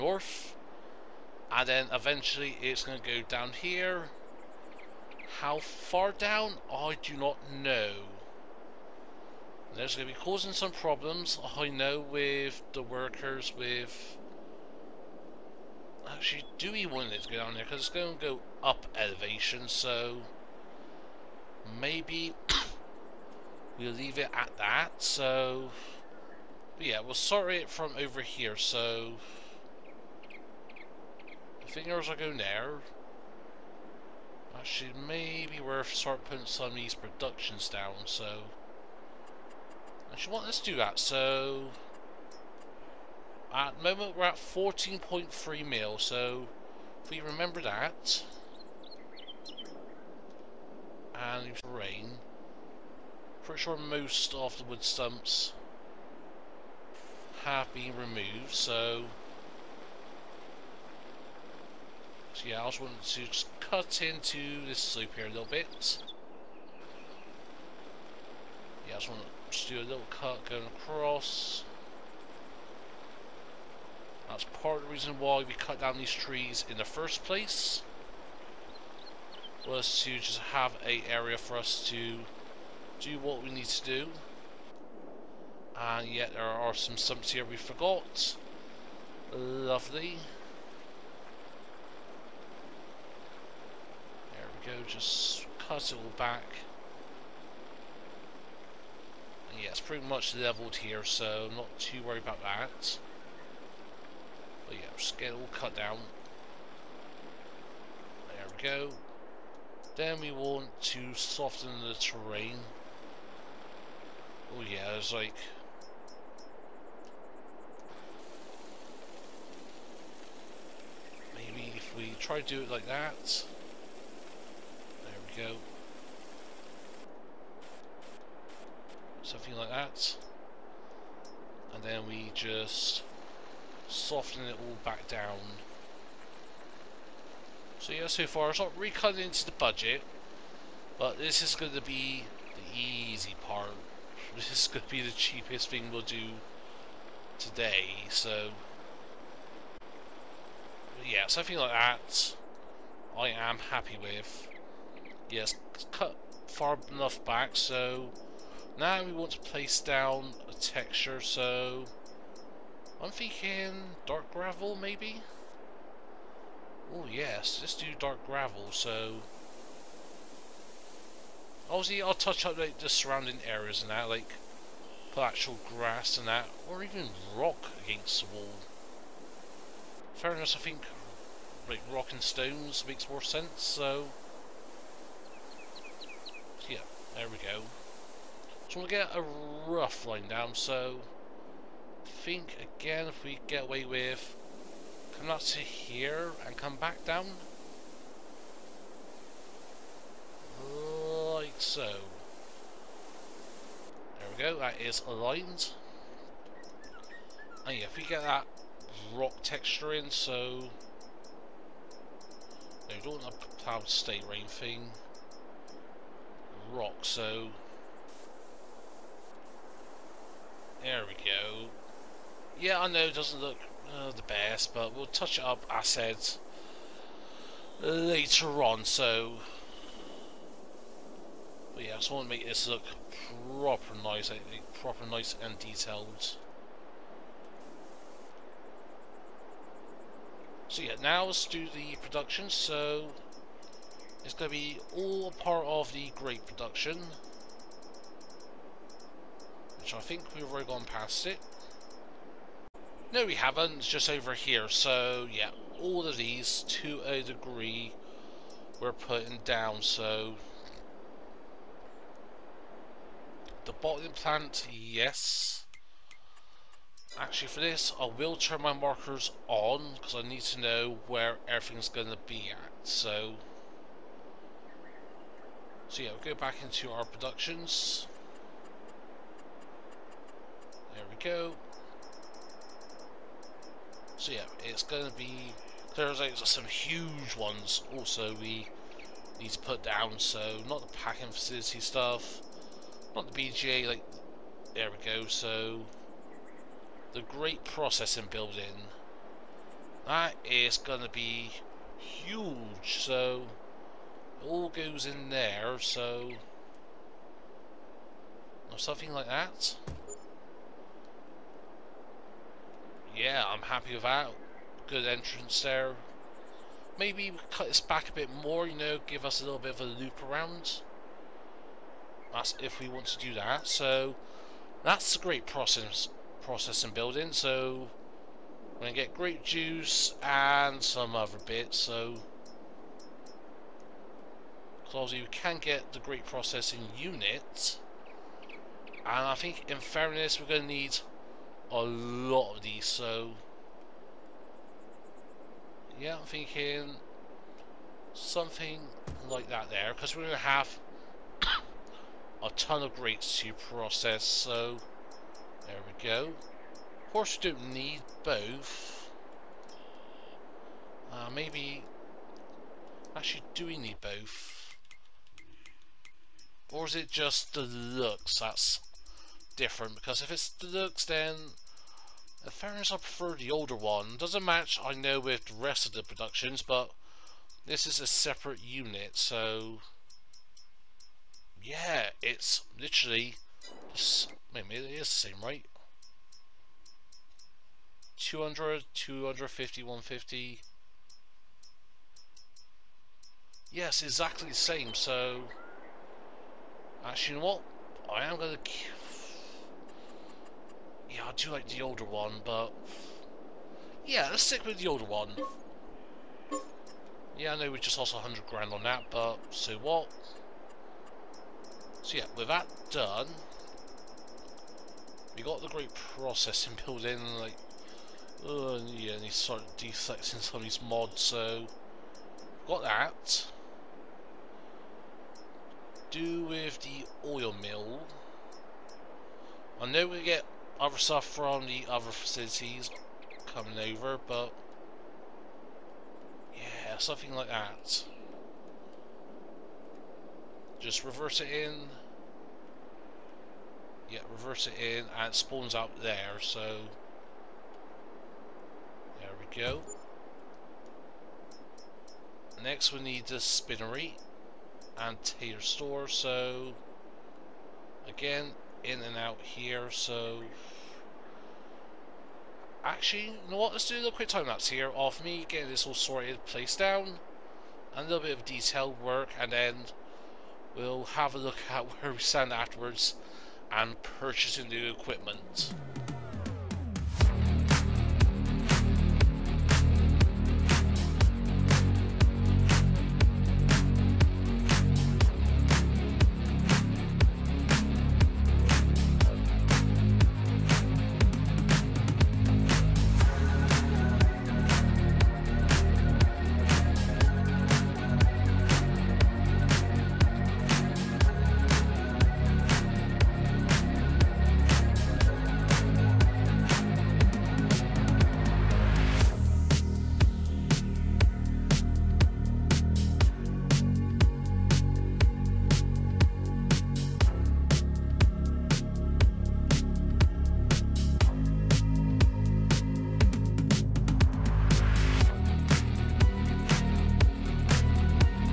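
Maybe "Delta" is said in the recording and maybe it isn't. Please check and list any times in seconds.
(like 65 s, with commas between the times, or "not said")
not said.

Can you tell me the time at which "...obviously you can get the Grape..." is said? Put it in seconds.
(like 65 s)
334 s.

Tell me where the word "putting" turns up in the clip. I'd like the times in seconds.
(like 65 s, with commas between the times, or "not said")
36 s, 258 s.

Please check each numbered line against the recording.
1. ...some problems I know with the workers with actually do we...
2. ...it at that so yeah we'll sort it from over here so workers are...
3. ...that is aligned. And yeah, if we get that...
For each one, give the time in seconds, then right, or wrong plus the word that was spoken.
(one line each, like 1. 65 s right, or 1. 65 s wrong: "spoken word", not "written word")
1. 10 s right
2. 24 s wrong: "fingers", not "workers"
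3. 204 s right.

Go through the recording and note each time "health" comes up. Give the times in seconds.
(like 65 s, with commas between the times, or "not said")
not said.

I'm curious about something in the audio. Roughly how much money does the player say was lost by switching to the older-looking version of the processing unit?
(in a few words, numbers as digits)
100 grand.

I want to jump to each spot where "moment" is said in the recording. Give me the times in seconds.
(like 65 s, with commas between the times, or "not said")
43 s.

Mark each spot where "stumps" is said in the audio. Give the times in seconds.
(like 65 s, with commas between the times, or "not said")
54 s, 86 s.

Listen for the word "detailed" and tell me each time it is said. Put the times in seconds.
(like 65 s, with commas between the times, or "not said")
235 s, 468 s.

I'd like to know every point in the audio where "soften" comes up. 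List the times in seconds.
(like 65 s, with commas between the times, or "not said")
111 s, 133 s.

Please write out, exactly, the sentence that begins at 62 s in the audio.
So yeah, I also wanted to cut into this loop here a little bit.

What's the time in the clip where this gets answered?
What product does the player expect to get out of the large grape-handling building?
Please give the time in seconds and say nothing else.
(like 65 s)
329 s.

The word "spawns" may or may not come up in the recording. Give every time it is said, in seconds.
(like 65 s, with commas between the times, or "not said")
445 s.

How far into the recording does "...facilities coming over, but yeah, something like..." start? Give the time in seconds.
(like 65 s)
432 s.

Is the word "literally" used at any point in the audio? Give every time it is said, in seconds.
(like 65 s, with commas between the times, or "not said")
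382 s.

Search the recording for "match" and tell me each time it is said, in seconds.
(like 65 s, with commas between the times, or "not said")
374 s.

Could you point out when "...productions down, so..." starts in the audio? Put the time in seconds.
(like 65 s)
36 s.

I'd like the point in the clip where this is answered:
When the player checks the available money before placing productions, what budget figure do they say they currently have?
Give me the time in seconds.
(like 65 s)
44 s.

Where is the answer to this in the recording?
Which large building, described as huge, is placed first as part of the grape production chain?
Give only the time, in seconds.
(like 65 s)
297 s.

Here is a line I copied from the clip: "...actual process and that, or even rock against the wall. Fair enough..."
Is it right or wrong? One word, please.
wrong.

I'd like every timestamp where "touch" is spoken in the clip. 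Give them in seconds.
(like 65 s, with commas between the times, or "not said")
172 s, 225 s.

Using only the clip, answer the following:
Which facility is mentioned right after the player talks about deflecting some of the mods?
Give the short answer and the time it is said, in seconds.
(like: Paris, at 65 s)
oil mill, at 427 s.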